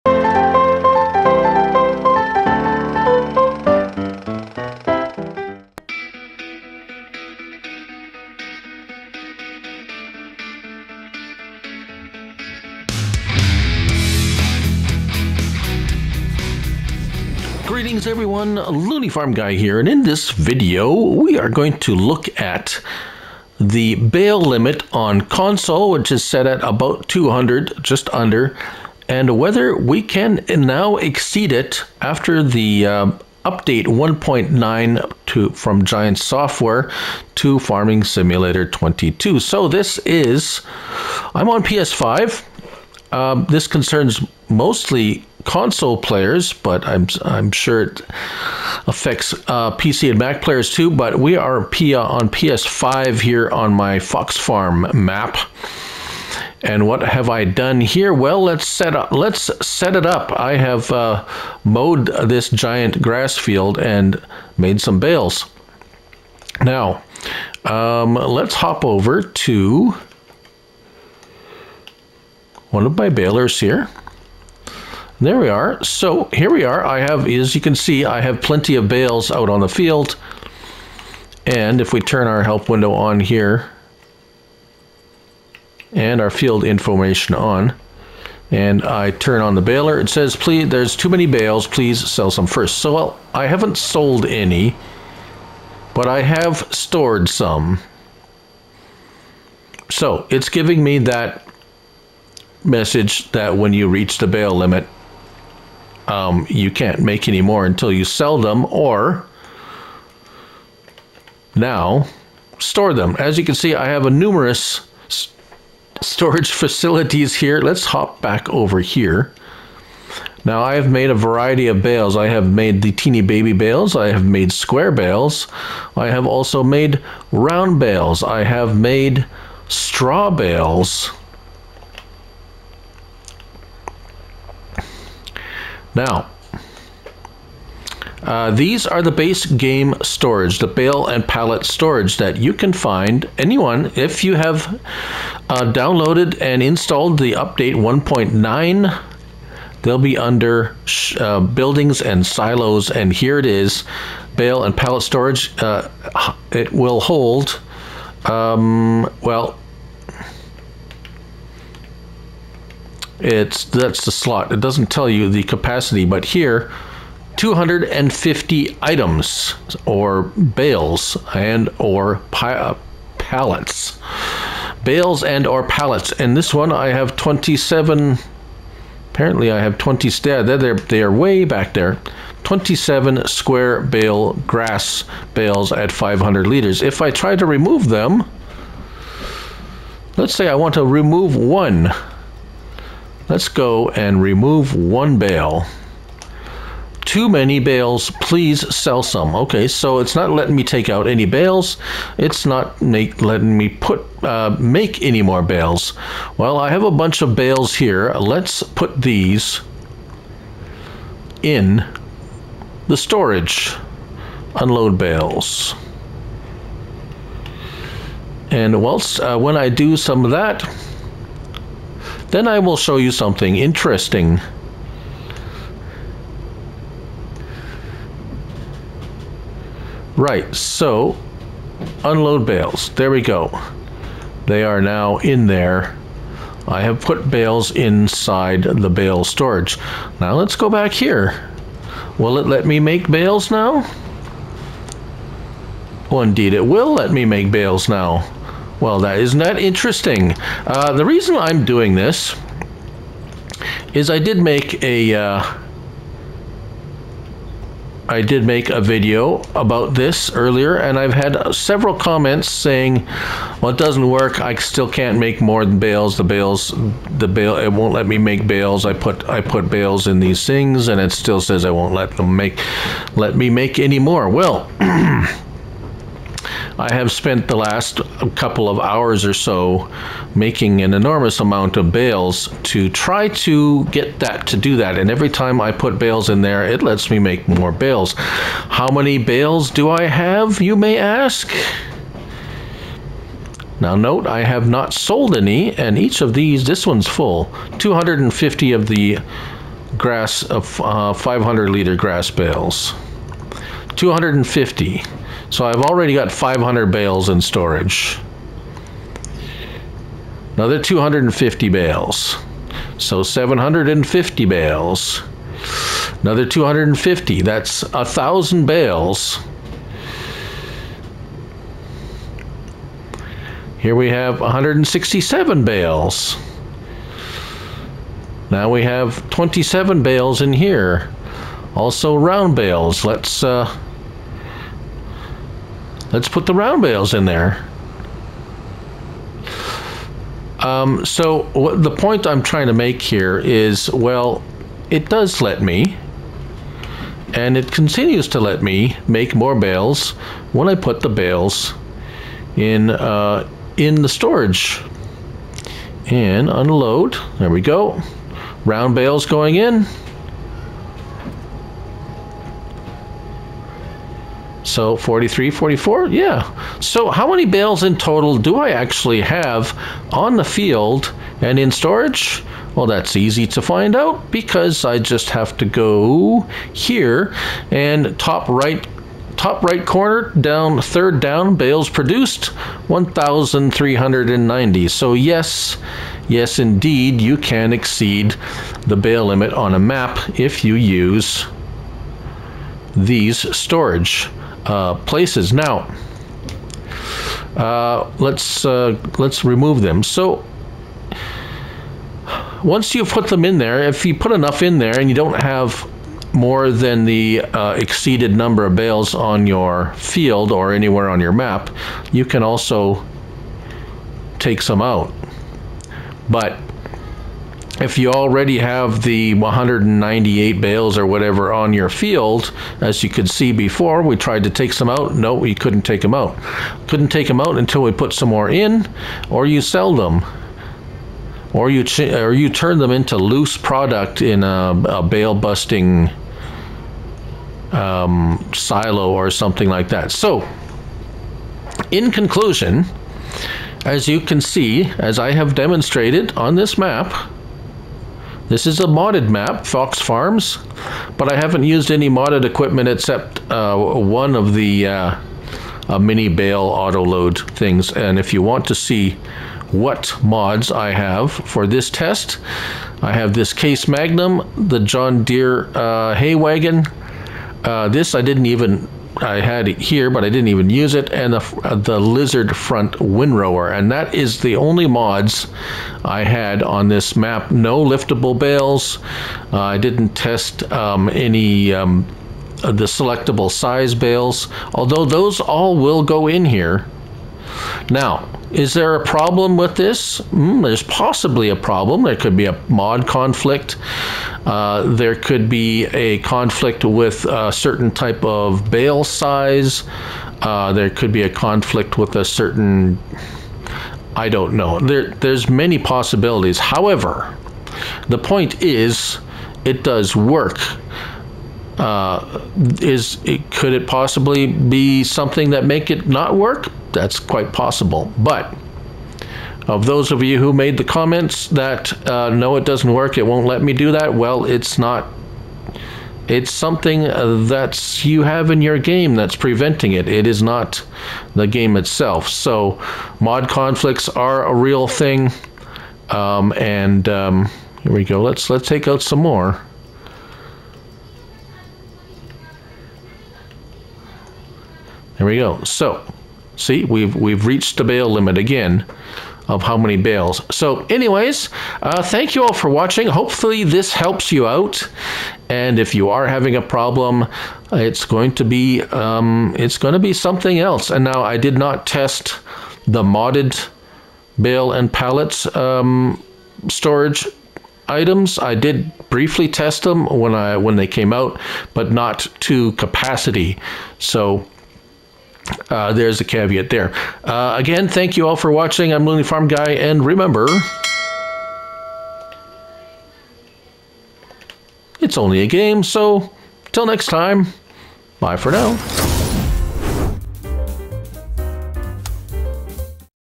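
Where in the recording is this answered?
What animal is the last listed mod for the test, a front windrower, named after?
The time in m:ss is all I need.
7:51.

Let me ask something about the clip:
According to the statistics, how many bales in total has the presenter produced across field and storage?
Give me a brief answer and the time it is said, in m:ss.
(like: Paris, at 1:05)
1390, at 6:22.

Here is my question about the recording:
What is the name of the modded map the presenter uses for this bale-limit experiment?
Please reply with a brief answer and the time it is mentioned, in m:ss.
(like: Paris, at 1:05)
Fox Farm, at 0:53.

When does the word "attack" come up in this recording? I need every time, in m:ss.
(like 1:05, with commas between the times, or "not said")
not said.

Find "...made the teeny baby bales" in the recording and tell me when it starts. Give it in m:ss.
2:02.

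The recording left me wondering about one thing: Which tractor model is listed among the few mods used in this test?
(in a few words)
Case Magnum.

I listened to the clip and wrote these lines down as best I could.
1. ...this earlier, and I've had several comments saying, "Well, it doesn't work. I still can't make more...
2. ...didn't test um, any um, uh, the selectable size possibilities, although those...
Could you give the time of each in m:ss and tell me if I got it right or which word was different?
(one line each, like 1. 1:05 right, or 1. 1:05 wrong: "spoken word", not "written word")
1. 4:19 right
2. 7:59 wrong: "bales", not "possibilities".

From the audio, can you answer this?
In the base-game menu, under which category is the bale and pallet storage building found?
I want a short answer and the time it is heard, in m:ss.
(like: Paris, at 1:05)
buildings and silos, at 2:31.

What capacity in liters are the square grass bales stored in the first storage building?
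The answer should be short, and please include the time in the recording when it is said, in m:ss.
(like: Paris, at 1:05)
500 liters, at 3:05.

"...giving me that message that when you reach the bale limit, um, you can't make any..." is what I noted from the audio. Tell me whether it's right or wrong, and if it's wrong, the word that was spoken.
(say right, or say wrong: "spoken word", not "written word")
right.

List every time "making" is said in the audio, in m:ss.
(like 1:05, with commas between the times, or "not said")
4:40.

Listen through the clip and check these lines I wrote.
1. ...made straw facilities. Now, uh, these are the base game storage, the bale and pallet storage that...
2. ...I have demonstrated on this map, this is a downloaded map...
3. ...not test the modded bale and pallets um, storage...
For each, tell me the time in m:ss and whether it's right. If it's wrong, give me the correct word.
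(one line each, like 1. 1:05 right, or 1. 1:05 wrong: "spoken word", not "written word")
1. 2:08 wrong: "bales", not "facilities"
2. 7:25 wrong: "modded", not "downloaded"
3. 9:21 right.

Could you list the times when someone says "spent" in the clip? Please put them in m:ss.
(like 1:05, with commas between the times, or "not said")
4:37.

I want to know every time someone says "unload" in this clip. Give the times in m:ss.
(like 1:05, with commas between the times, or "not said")
3:34, 3:52, 5:56.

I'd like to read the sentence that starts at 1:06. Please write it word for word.
Now, um, let's hop over to one of my balers here.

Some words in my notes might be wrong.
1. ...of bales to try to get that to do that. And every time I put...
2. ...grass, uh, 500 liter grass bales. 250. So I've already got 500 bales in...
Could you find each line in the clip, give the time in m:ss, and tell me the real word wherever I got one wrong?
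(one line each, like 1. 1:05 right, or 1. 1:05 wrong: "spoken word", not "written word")
1. 4:41 right
2. 4:59 right.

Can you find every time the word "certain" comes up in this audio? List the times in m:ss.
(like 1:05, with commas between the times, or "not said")
8:17, 8:22.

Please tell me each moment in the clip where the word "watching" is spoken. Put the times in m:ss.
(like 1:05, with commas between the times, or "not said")
9:12, 9:38.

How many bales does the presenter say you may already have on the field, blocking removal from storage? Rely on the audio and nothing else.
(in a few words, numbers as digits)
198.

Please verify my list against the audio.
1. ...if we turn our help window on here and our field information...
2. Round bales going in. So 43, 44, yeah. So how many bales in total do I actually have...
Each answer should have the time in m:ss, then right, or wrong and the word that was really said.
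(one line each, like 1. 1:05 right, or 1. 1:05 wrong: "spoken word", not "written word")
1. 1:21 right
2. 5:58 right.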